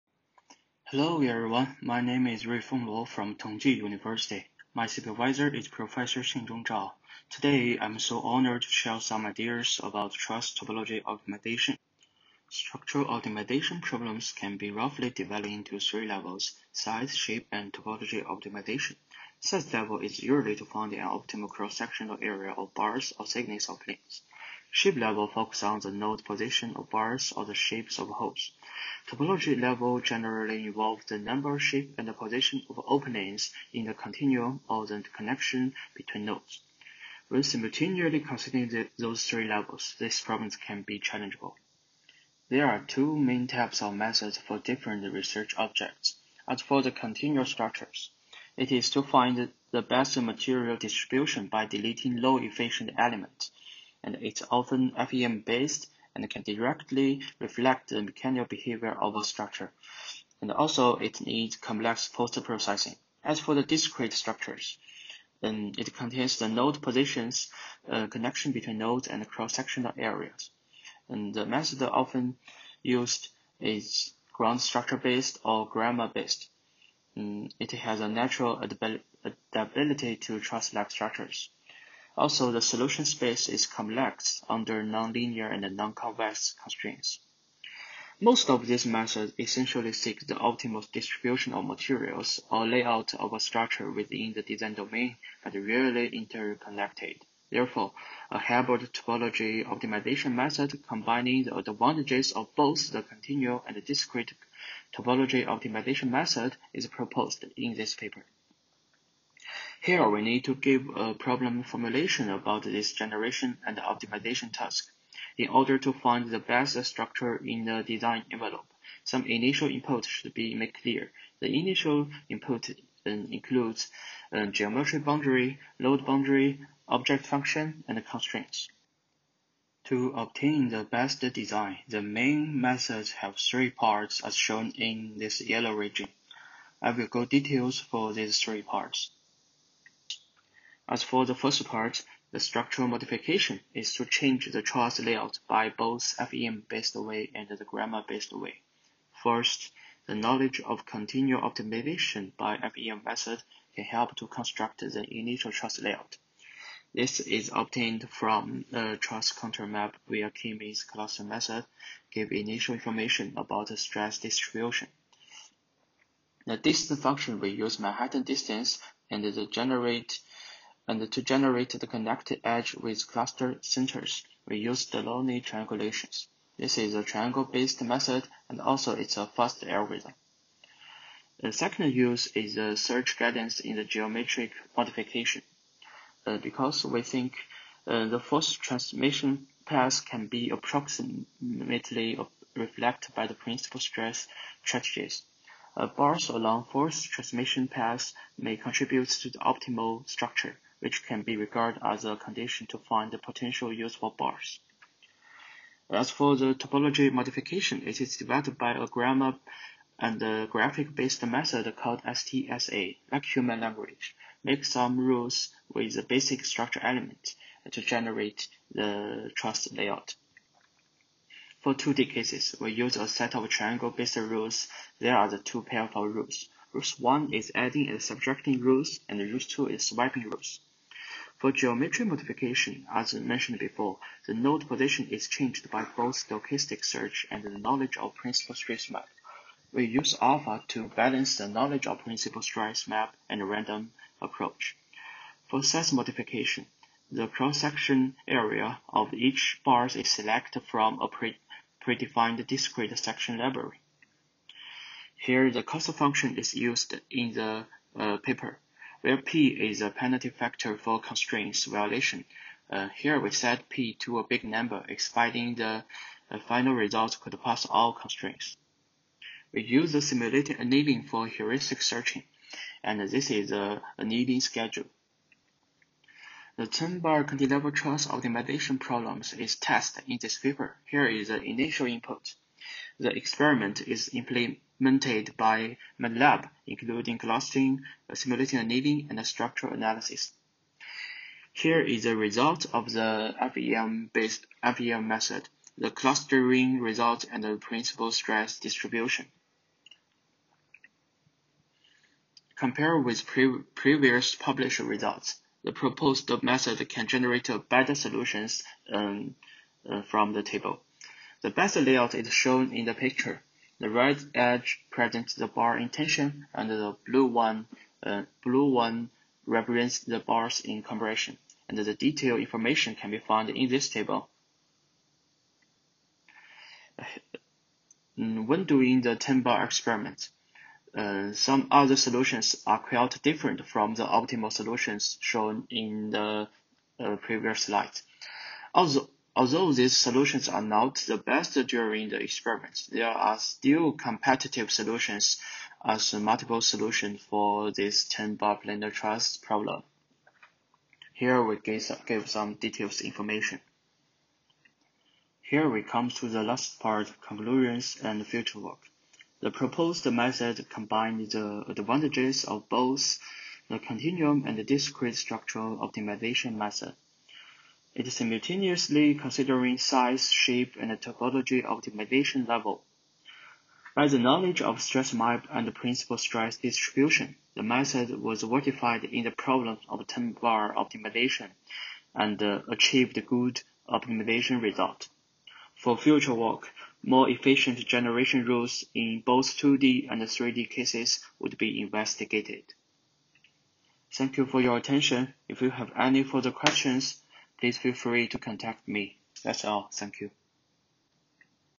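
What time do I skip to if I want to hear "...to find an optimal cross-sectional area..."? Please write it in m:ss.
0:20.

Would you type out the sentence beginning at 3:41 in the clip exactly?
For 2D cases, we use a set of triangle-based rules.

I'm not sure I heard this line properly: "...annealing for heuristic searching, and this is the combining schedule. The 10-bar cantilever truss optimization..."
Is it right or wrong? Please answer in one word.
wrong.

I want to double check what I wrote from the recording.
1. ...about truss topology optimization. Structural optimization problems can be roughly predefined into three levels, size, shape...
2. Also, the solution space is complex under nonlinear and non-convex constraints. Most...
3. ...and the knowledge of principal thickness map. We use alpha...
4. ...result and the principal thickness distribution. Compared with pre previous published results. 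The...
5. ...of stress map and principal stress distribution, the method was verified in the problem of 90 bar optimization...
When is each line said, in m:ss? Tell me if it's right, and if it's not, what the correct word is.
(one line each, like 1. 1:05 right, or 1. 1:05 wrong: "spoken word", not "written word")
1. 0:09 wrong: "divided", not "predefined"
2. 1:22 right
3. 3:57 wrong: "stress", not "thickness"
4. 4:56 wrong: "stress", not "thickness"
5. 6:14 wrong: "10", not "90".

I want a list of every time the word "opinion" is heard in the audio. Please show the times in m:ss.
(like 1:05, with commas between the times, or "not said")
not said.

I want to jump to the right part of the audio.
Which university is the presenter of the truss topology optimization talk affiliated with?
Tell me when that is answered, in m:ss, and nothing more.
0:03.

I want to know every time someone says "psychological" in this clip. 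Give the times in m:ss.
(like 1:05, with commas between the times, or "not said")
not said.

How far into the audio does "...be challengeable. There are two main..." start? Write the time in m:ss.
0:40.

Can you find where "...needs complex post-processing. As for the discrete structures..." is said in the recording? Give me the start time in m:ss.
1:01.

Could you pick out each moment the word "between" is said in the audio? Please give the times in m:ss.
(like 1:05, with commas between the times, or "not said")
0:35, 1:08.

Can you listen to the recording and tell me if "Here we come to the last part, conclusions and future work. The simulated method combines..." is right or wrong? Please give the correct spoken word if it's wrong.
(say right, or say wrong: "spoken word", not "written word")
wrong: "proposed", not "simulated".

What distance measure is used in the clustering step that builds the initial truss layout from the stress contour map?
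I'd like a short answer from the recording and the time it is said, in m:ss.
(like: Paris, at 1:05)
Manhattan distance, at 2:47.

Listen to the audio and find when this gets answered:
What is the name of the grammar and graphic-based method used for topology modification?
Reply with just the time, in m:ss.
3:32.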